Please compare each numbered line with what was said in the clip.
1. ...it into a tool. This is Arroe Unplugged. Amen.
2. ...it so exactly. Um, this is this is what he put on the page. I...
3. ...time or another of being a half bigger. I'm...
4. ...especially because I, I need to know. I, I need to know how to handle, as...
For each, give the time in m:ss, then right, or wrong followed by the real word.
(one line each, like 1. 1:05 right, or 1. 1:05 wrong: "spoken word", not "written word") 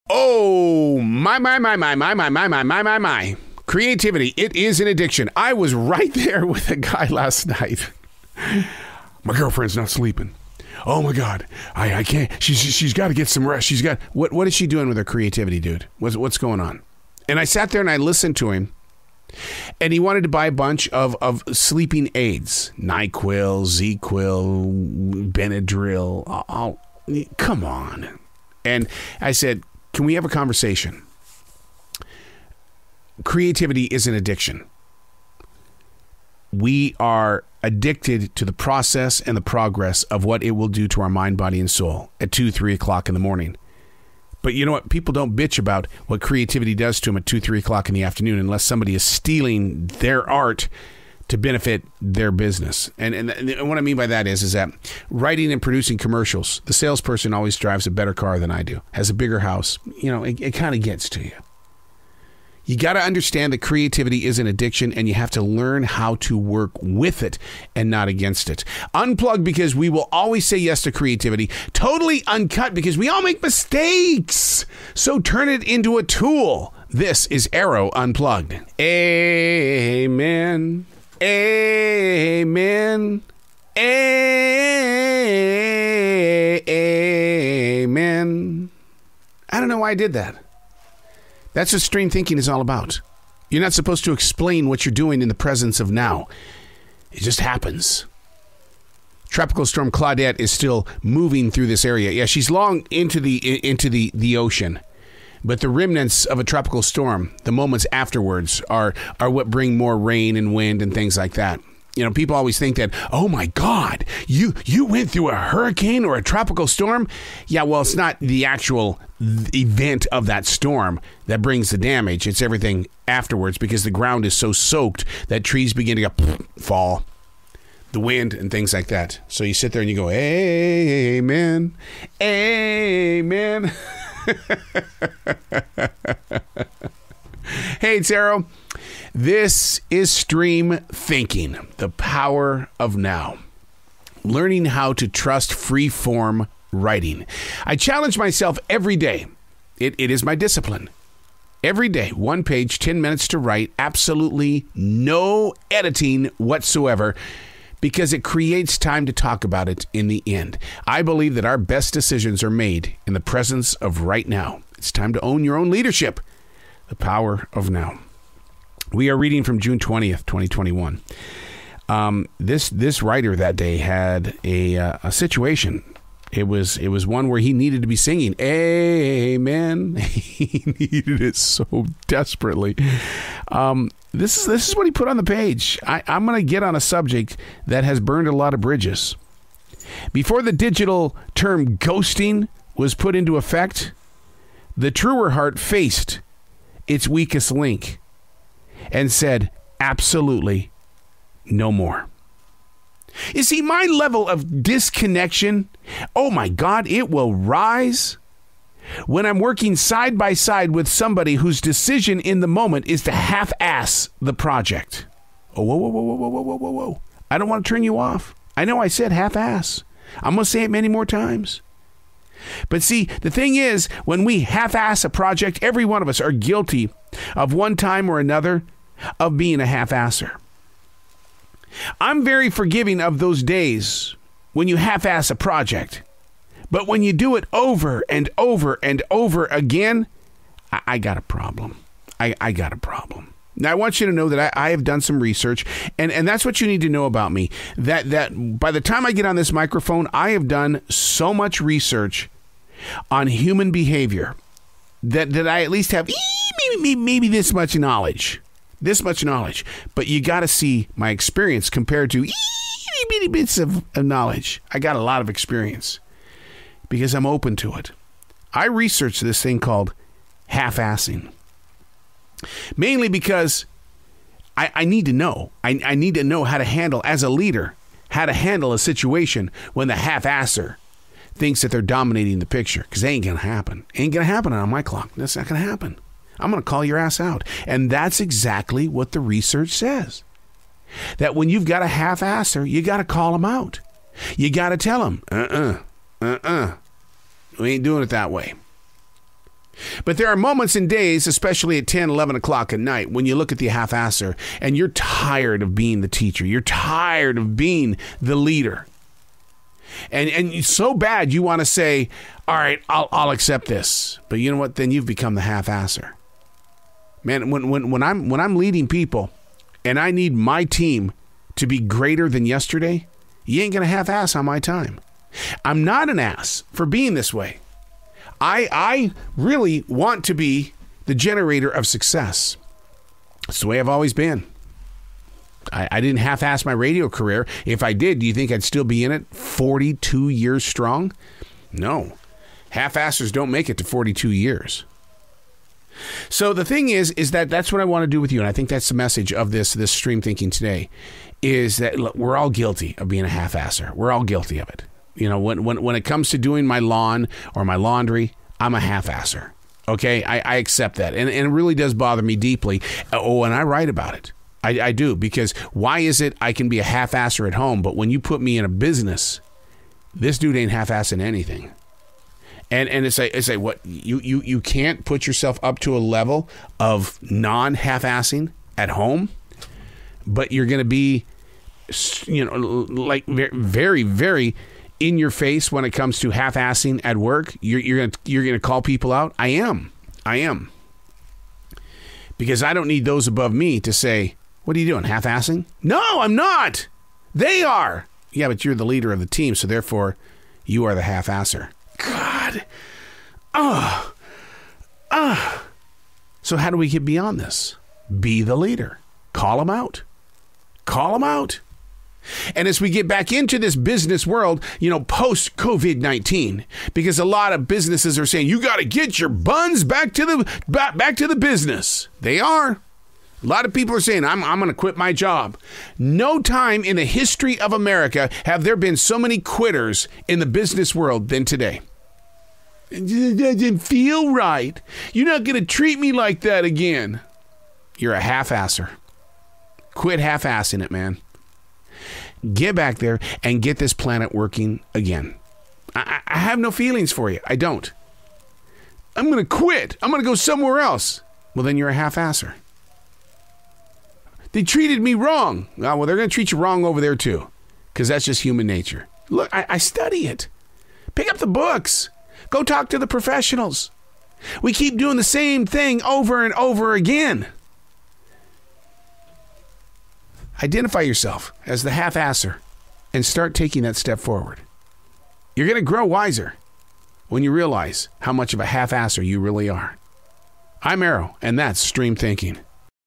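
1. 1:15 right
2. 3:01 wrong: "desperately", not "exactly"
3. 3:47 wrong: "asser", not "bigger"
4. 4:32 wrong: "mainly", not "especially".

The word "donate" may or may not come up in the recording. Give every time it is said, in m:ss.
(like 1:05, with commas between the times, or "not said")
not said.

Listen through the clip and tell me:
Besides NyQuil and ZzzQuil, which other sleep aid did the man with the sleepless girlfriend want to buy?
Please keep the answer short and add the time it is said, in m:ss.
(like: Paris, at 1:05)
Benadryl, at 0:25.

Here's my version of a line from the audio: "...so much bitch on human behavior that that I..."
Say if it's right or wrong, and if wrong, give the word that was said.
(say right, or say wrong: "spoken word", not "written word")
wrong: "research", not "bitch".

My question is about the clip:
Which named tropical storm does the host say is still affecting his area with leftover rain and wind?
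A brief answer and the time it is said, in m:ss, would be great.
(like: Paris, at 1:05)
Claudette, at 1:39.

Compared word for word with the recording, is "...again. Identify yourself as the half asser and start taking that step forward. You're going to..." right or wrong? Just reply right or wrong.
right.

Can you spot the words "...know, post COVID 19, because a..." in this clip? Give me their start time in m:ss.
6:54.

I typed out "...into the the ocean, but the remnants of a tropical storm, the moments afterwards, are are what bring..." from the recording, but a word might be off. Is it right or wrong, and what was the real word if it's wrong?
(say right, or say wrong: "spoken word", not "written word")
right.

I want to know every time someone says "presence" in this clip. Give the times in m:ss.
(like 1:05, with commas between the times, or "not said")
1:35, 2:43.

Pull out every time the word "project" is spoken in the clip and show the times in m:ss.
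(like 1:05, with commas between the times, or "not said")
3:34, 3:45, 3:55.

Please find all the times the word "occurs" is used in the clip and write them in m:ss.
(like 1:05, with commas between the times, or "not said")
not said.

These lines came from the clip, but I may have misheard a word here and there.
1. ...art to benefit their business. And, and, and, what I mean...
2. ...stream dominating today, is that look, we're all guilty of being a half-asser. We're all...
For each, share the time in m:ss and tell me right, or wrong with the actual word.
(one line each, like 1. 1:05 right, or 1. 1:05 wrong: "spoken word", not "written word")
1. 0:50 right
2. 5:49 wrong: "thinking", not "dominating".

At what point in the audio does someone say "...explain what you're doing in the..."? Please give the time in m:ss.
1:34.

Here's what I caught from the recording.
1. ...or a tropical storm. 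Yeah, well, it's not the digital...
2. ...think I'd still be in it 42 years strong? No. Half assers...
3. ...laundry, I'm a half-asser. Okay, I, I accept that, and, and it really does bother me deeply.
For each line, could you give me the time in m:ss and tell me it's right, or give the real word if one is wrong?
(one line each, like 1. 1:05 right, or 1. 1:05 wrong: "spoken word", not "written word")
1. 1:56 wrong: "actual", not "digital"
2. 5:38 right
3. 5:57 right.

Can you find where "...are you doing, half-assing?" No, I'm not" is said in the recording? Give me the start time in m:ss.
6:34.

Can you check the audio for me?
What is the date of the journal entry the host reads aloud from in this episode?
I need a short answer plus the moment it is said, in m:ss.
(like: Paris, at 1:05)
June 20th, 2021, at 2:49.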